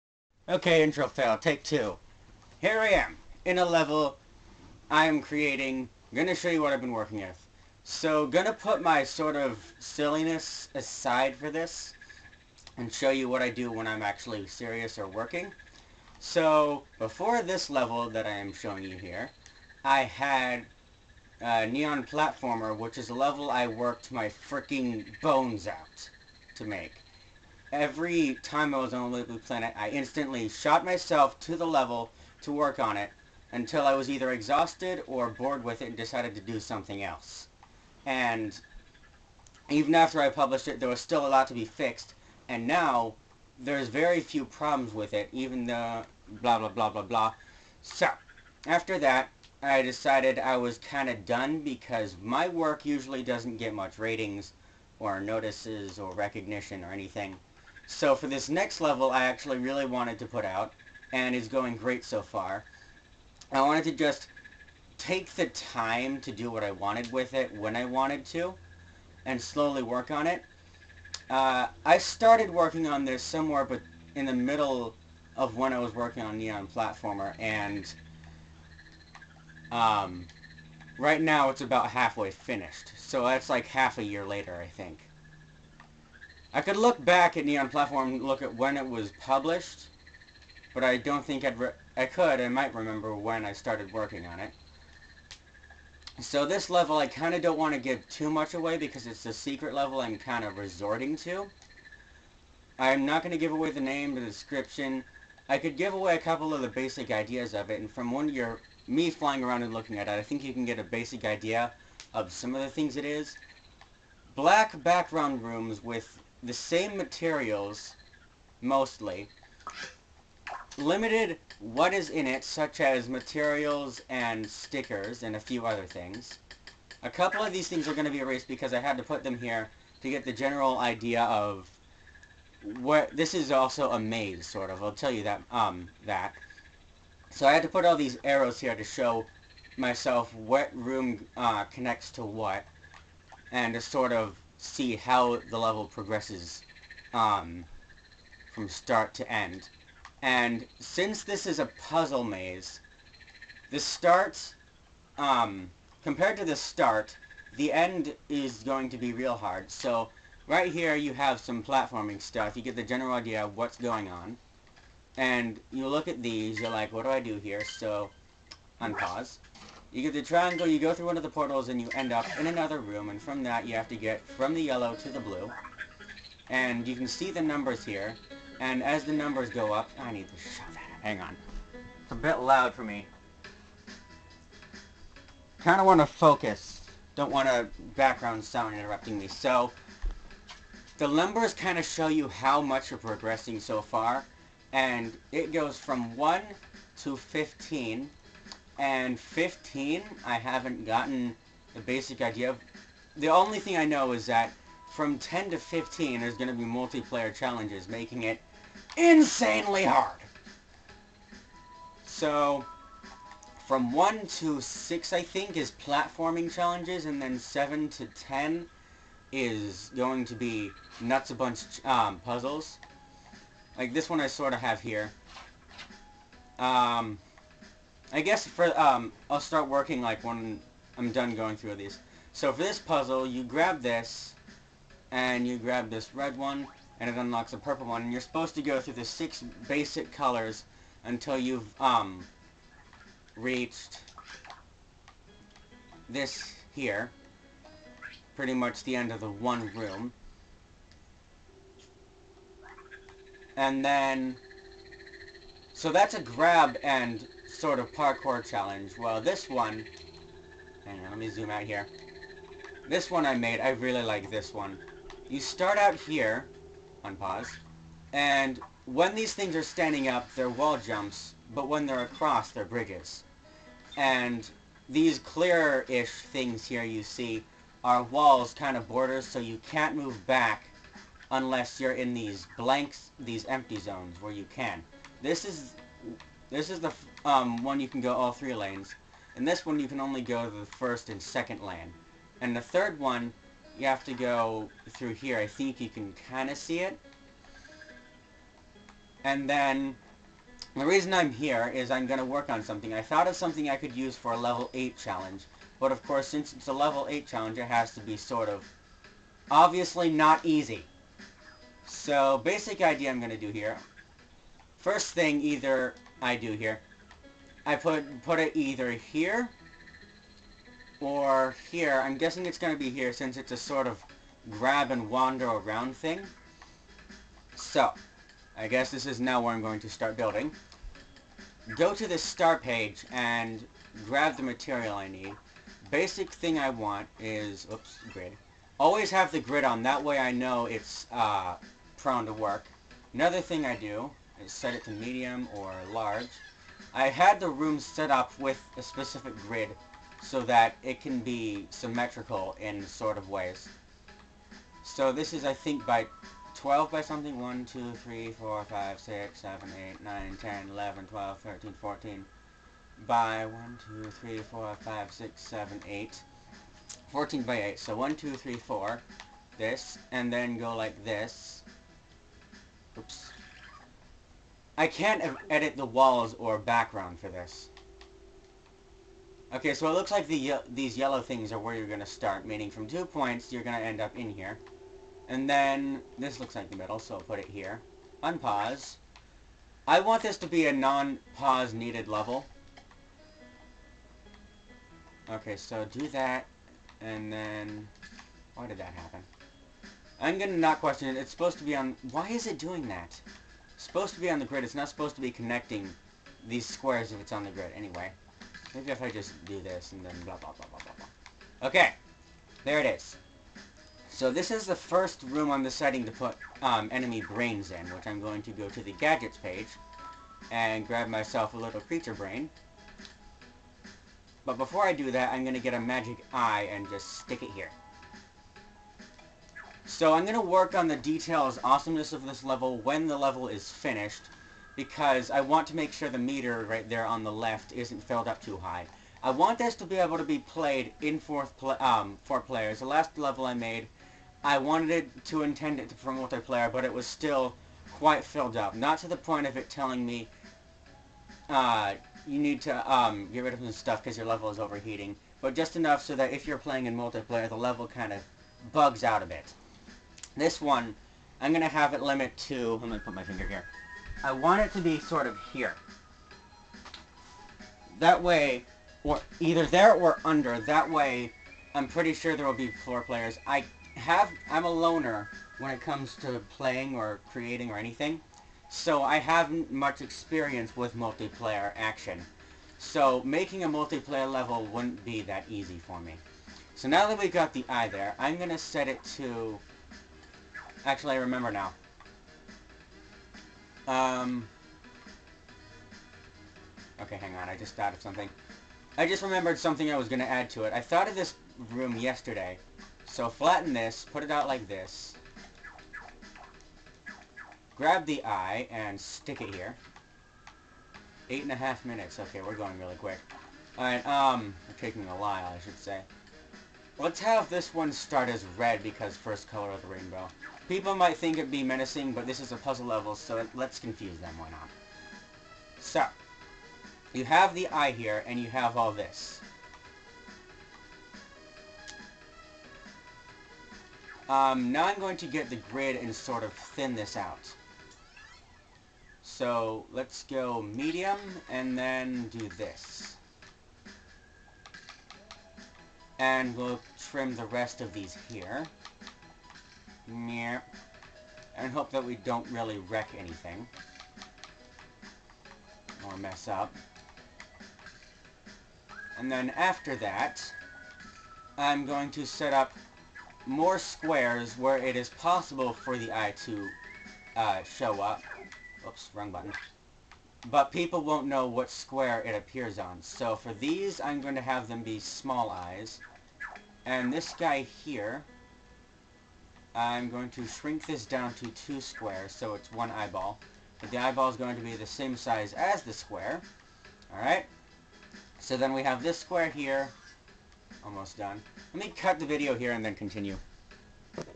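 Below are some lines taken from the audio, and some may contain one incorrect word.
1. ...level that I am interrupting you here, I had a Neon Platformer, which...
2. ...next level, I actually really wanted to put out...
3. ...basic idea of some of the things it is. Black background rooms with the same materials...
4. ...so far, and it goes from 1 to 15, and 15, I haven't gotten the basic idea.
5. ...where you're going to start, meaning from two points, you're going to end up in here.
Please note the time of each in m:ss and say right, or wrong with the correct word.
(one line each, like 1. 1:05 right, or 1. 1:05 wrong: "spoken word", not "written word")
1. 0:17 wrong: "showing", not "interrupting"
2. 0:58 right
3. 1:50 right
4. 3:13 right
5. 6:21 right.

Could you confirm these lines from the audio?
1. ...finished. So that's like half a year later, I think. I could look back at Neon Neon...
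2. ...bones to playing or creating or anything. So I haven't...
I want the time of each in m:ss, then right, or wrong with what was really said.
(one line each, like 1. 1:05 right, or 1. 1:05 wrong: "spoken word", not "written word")
1. 1:22 wrong: "Platform", not "Neon"
2. 7:55 wrong: "comes", not "bones".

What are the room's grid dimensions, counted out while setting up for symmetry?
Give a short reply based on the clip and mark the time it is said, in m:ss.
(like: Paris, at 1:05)
14 by 8, at 6:07.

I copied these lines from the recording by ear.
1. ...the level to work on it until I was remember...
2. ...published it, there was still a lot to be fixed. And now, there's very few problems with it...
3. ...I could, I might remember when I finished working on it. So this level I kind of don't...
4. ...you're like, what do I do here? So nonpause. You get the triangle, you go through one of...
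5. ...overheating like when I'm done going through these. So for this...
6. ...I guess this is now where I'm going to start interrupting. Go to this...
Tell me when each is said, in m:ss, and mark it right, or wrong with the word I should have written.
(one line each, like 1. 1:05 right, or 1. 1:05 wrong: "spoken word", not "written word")
1. 0:31 wrong: "either", not "remember"
2. 0:40 right
3. 1:31 wrong: "started", not "finished"
4. 2:46 wrong: "unpause", not "nonpause"
5. 3:49 wrong: "working", not "overheating"
6. 5:28 wrong: "building", not "interrupting".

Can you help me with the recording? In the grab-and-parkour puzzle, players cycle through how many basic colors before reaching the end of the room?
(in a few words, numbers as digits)
6.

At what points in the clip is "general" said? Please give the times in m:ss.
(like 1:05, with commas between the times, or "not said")
2:10, 2:42.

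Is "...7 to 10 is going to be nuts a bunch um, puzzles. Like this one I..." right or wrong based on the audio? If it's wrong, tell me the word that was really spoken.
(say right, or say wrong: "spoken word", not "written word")
right.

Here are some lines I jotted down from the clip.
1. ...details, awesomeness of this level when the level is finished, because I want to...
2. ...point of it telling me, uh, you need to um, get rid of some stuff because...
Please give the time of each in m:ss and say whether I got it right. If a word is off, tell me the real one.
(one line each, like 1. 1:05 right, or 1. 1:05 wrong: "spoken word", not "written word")
1. 7:10 right
2. 7:29 right.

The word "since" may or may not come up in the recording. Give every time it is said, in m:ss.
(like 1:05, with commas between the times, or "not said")
2:30, 5:06, 5:23.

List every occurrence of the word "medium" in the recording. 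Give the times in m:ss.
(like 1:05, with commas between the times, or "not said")
5:44, 9:00.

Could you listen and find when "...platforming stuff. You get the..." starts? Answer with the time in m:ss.
2:41.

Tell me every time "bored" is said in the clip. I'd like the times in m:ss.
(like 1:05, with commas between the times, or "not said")
0:35.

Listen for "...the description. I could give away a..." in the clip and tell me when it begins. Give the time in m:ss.
1:44.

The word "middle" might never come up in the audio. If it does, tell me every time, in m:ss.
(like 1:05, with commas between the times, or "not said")
1:14, 6:26.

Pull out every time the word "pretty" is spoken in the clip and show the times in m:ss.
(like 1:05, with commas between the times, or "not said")
4:08, 7:51.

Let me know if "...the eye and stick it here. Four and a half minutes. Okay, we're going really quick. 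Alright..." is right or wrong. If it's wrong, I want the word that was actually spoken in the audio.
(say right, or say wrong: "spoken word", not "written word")
wrong: "Eight", not "Four".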